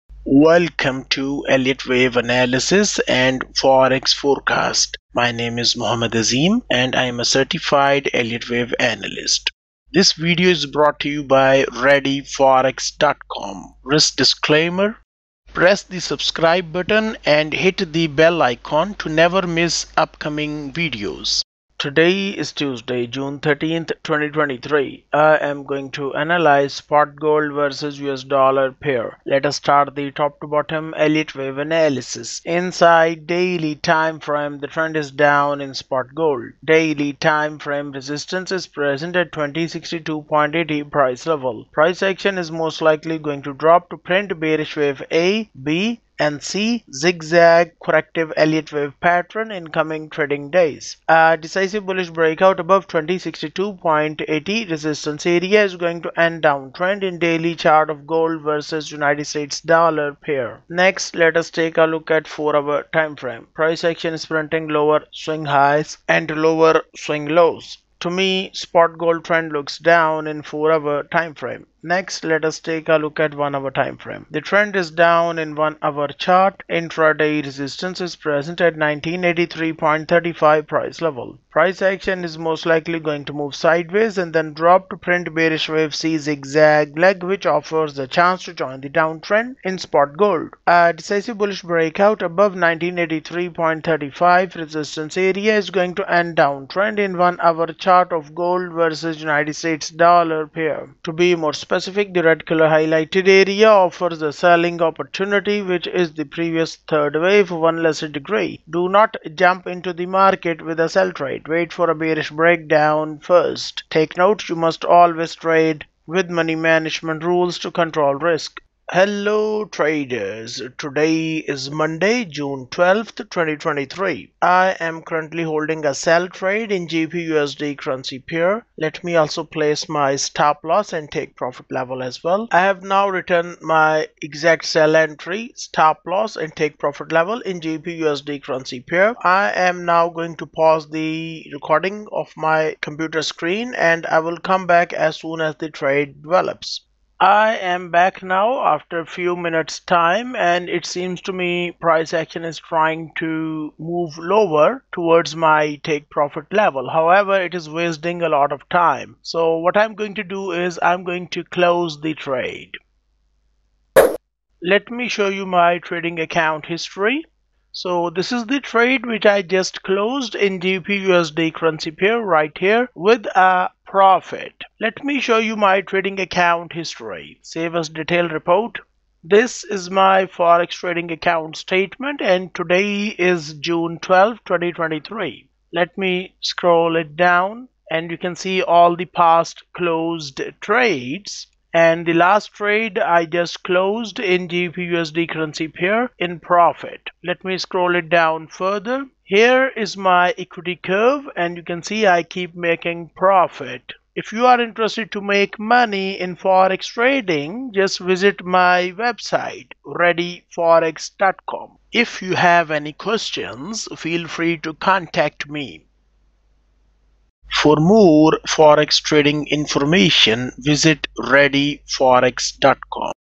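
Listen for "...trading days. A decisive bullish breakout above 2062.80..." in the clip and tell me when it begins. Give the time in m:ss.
0:50.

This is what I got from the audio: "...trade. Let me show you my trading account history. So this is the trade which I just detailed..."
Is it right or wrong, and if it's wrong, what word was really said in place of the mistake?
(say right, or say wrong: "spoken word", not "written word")
wrong: "closed", not "detailed".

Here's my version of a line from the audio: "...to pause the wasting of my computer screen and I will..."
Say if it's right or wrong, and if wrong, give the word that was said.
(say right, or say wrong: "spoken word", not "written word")
wrong: "recording", not "wasting".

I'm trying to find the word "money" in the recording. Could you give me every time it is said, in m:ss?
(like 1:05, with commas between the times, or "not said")
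1:56, 3:25.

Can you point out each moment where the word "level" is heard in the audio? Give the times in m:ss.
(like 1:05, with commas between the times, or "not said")
0:41, 1:21, 2:11, 2:17, 2:36.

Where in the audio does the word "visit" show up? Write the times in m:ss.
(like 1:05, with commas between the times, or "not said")
3:28, 3:40.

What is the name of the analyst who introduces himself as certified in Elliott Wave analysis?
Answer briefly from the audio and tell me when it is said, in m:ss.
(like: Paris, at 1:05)
Mohammed Azim, at 0:05.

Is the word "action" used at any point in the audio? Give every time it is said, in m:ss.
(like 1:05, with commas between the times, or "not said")
0:42, 1:03, 1:21, 2:32.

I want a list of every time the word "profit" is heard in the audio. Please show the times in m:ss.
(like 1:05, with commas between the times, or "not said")
2:11, 2:16, 2:36, 2:53, 3:16, 3:23.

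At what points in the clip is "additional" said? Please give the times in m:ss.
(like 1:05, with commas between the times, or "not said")
not said.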